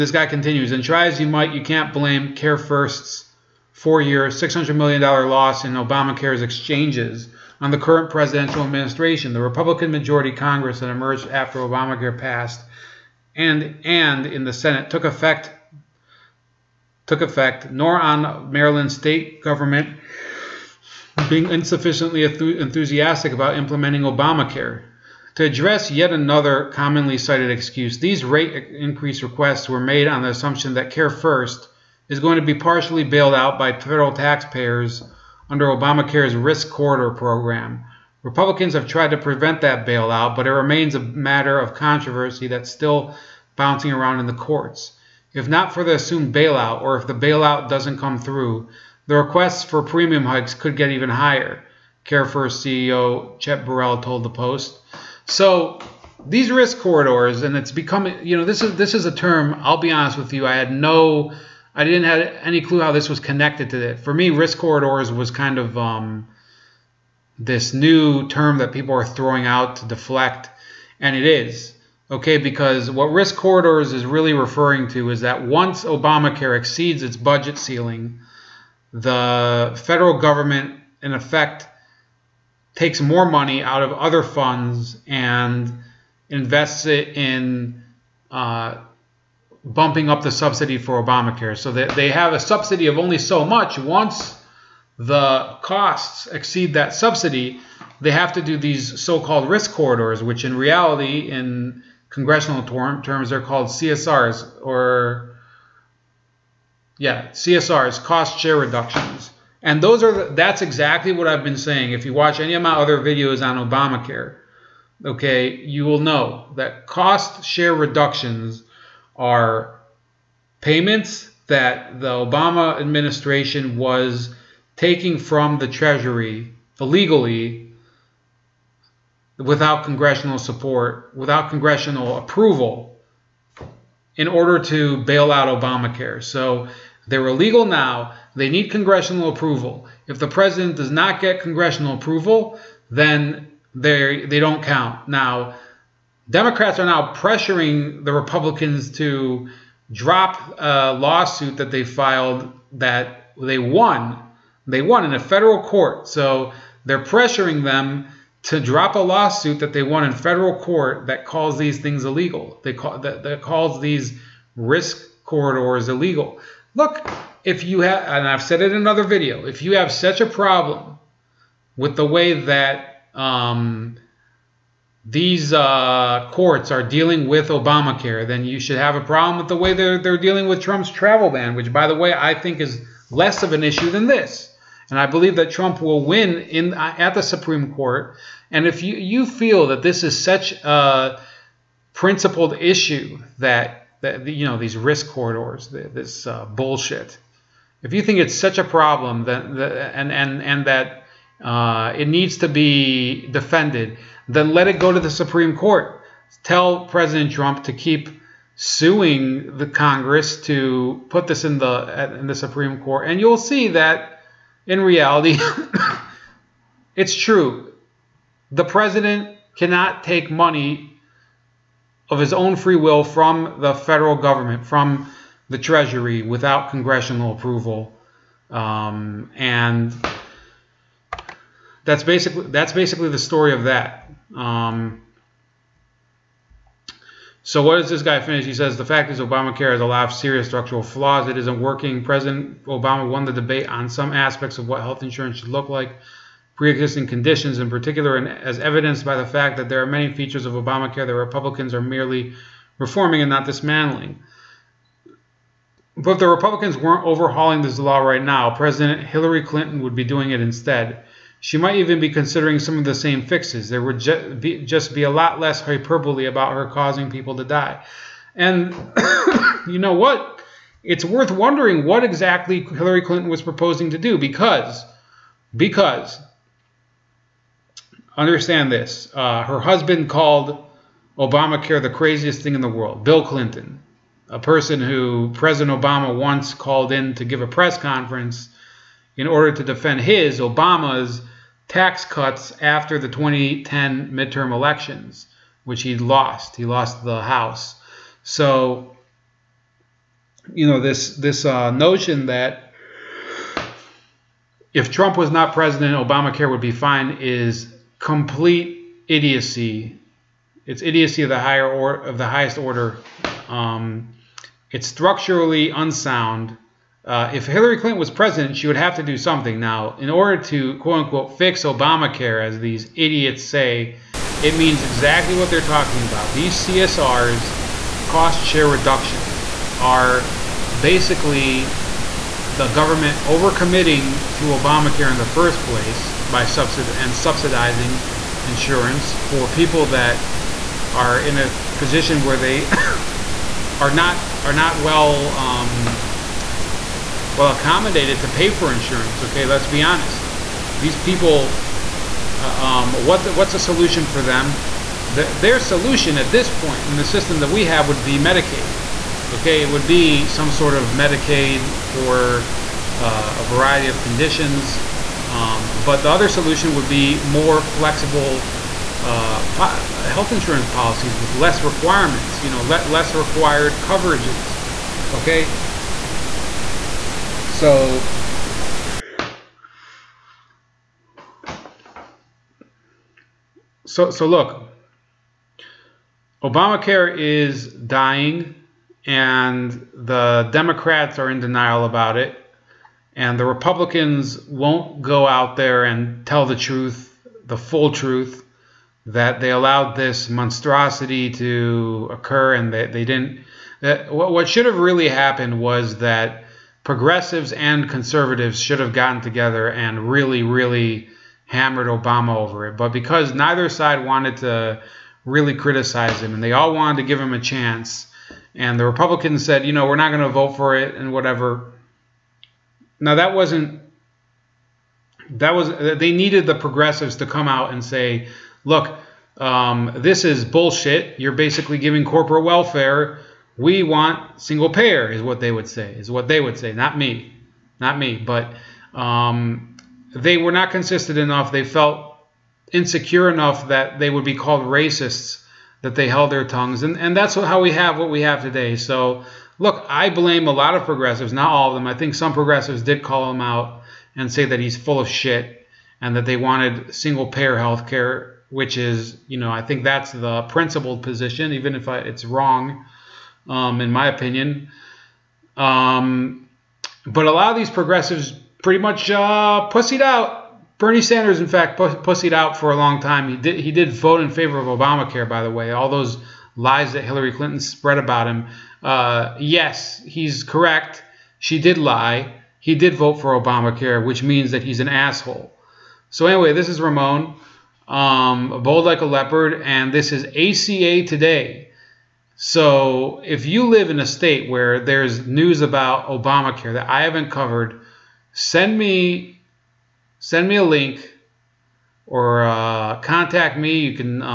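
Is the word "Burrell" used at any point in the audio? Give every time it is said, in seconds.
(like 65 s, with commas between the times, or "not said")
53 s.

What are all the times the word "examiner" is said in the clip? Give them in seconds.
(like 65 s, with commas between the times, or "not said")
not said.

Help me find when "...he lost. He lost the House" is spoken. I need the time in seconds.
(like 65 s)
295 s.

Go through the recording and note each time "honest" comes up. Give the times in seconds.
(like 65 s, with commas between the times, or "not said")
59 s, 349 s.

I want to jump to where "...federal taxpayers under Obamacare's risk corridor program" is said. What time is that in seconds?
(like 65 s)
33 s.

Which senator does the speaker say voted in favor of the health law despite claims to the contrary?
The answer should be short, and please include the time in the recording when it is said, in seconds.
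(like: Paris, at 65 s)
Bernie Sanders, at 470 s.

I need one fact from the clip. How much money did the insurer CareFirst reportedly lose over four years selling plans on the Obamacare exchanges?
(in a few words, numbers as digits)
$600 million.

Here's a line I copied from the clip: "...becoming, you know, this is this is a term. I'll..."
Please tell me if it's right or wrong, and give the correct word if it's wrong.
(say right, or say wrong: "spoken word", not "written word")
right.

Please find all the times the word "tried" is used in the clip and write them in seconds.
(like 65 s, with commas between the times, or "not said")
38 s.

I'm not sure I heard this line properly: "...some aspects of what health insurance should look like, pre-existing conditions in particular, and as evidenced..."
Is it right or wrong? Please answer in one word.
right.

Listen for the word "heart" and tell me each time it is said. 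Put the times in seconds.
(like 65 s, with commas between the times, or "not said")
not said.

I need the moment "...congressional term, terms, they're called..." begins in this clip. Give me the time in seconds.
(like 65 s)
102 s.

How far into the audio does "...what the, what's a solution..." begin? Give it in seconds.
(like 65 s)
352 s.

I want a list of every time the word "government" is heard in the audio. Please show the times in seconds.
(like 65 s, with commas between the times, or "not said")
19 s, 80 s, 224 s, 332 s.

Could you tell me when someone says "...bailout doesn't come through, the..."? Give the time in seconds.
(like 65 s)
47 s.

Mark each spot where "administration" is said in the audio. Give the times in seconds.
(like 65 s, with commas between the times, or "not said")
8 s, 122 s.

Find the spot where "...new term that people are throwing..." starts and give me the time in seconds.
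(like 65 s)
67 s.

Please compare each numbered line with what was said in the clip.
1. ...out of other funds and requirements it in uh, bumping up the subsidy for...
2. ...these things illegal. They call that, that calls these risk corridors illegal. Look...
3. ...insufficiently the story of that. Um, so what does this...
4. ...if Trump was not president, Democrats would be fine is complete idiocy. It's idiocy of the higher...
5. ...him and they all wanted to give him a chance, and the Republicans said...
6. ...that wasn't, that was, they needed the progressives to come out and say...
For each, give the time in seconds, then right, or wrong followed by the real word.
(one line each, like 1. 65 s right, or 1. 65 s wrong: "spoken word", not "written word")
1. 83 s wrong: "invests", not "requirements"
2. 161 s right
3. 232 s wrong: "basically", not "insufficiently"
4. 304 s wrong: "Obamacare", not "Democrats"
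5. 416 s right
6. 423 s right.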